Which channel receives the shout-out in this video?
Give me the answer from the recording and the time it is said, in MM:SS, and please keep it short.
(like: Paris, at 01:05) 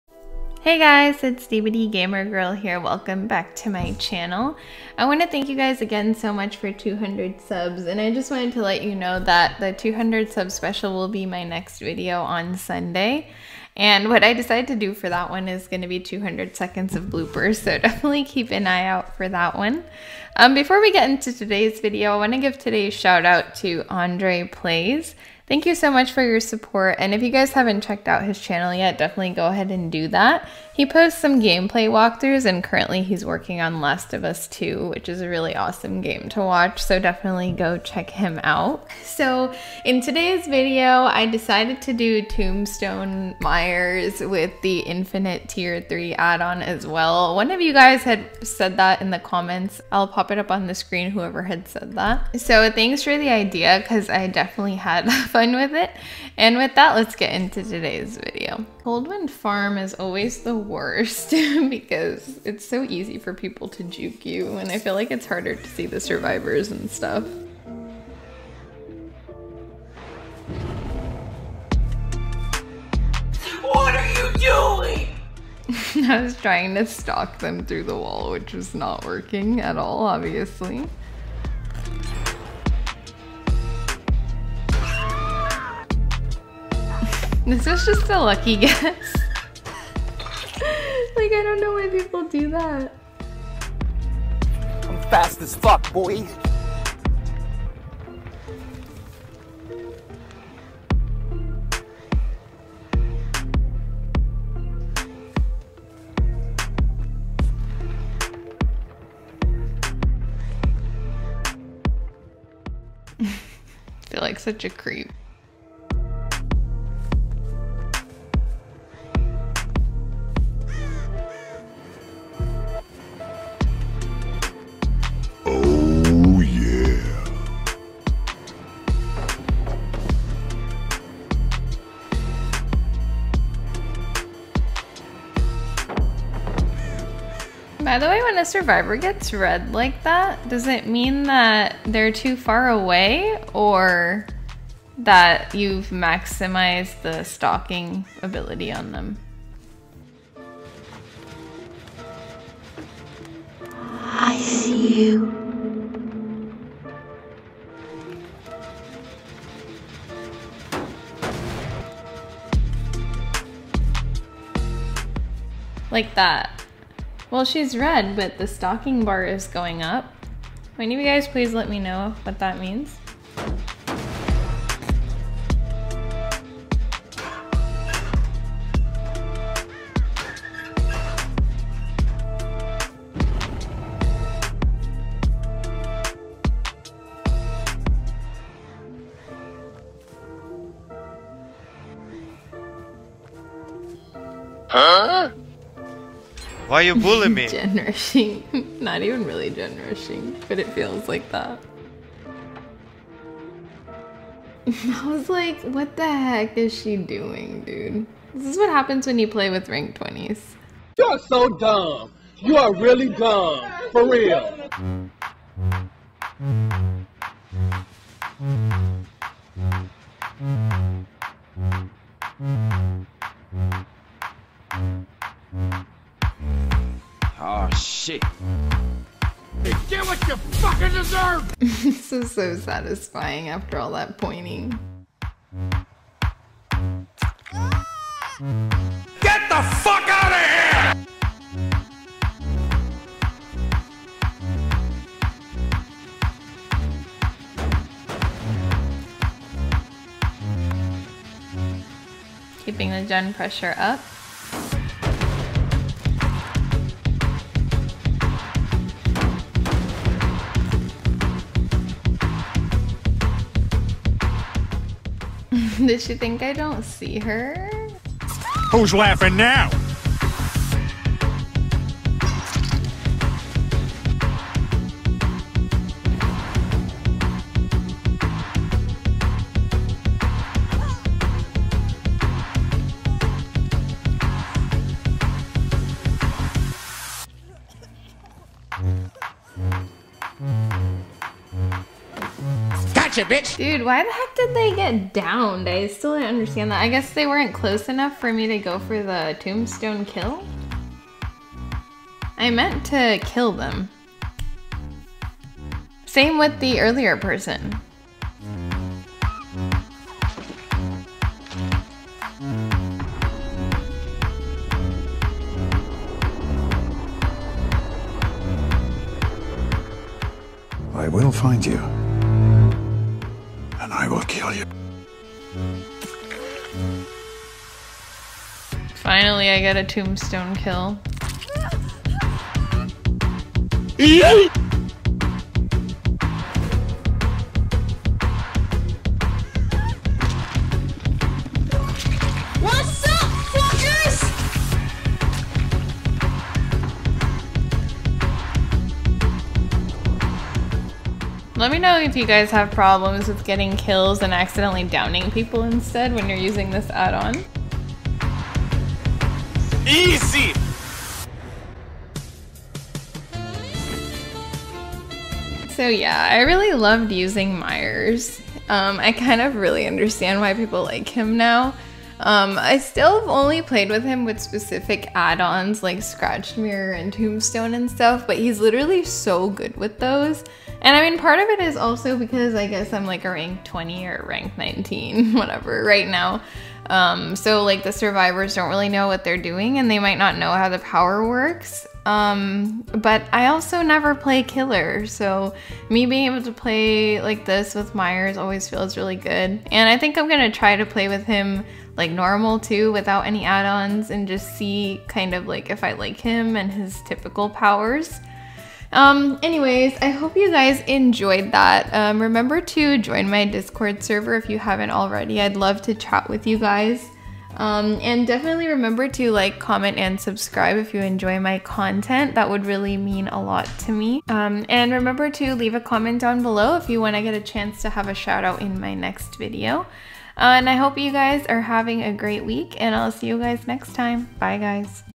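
Andre Plays, at 00:23.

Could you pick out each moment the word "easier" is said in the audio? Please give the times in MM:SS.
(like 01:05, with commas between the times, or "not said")
not said.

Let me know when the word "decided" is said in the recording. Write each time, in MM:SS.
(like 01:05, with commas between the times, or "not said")
00:14, 00:41.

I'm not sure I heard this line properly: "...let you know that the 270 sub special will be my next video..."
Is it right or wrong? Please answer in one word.
wrong.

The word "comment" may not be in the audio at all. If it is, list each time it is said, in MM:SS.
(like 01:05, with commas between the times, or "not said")
00:49, 06:59, 07:05.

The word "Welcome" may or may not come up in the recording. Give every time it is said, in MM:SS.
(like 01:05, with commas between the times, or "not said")
00:02.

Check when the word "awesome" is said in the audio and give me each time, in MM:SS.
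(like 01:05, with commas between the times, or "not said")
00:35.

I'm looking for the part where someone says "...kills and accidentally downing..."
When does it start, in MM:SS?
05:53.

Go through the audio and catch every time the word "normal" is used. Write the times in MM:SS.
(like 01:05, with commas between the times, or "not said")
06:42.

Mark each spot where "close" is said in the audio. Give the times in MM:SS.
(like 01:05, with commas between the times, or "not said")
04:57.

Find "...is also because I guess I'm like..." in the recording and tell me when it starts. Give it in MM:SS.
06:21.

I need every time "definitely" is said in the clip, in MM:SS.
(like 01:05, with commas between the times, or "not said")
00:17, 00:28, 00:36, 00:54, 06:58.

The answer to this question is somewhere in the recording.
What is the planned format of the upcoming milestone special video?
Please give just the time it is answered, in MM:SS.
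00:15.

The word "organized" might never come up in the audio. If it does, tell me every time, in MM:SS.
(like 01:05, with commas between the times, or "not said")
not said.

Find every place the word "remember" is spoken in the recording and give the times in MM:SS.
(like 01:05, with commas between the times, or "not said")
06:52, 06:58, 07:04.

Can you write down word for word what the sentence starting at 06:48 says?
Um, anyways, I hope you guys enjoyed that.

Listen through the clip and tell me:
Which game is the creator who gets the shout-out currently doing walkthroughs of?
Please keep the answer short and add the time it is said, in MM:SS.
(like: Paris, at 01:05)
Last of Us 2, at 00:33.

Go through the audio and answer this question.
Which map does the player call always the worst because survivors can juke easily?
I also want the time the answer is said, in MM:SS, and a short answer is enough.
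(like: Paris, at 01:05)
Wind Farm, at 00:58.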